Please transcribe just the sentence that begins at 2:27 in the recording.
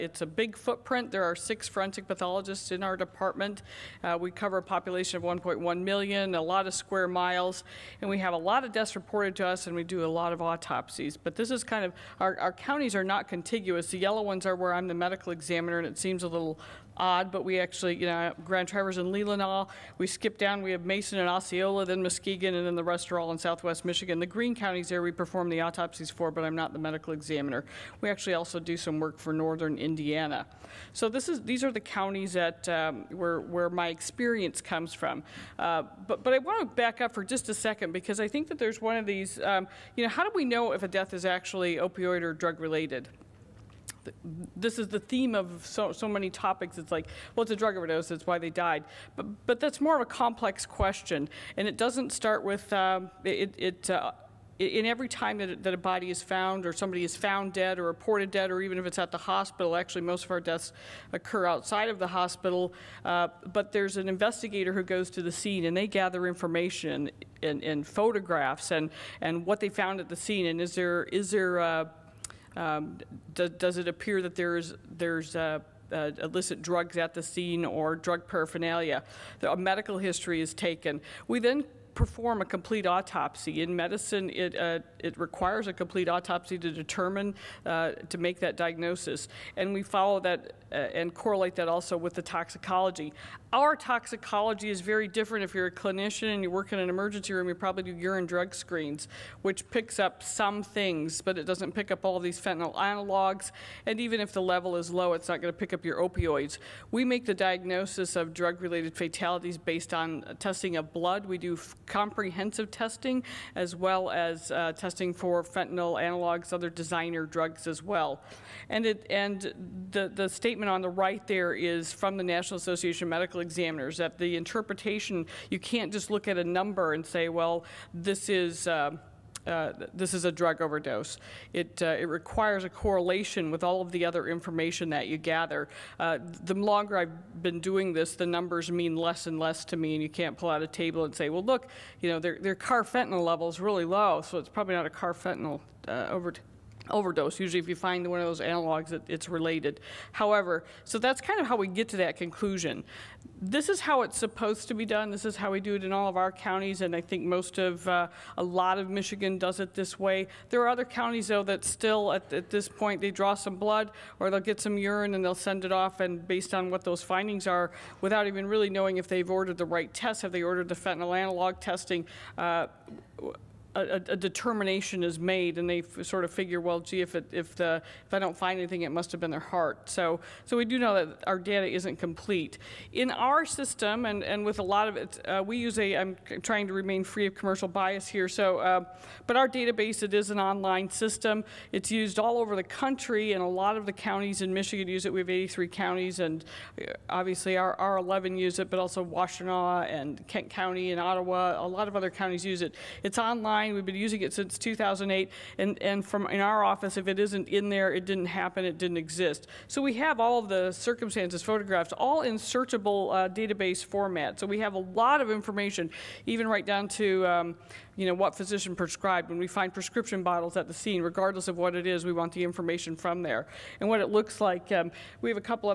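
Usually, if you find one of those analogs, it, it's related.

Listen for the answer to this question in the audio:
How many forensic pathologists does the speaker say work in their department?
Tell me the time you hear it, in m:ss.
0:01.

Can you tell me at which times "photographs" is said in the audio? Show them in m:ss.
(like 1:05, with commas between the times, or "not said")
1:07, 3:31.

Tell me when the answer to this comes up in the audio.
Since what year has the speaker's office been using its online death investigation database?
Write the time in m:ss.
3:24.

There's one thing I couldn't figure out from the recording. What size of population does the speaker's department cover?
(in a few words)
1.1 million.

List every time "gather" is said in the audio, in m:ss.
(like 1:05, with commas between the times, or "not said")
1:05, 2:15.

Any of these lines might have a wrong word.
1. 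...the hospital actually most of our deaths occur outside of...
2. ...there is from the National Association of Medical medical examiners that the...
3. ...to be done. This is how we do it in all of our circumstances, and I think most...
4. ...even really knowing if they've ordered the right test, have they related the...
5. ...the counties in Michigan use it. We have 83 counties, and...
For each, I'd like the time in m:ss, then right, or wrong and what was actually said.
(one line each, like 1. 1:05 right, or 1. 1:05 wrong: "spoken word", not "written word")
1. 0:59 right
2. 2:01 right
3. 2:34 wrong: "counties", not "circumstances"
4. 2:48 wrong: "ordered", not "related"
5. 3:13 right.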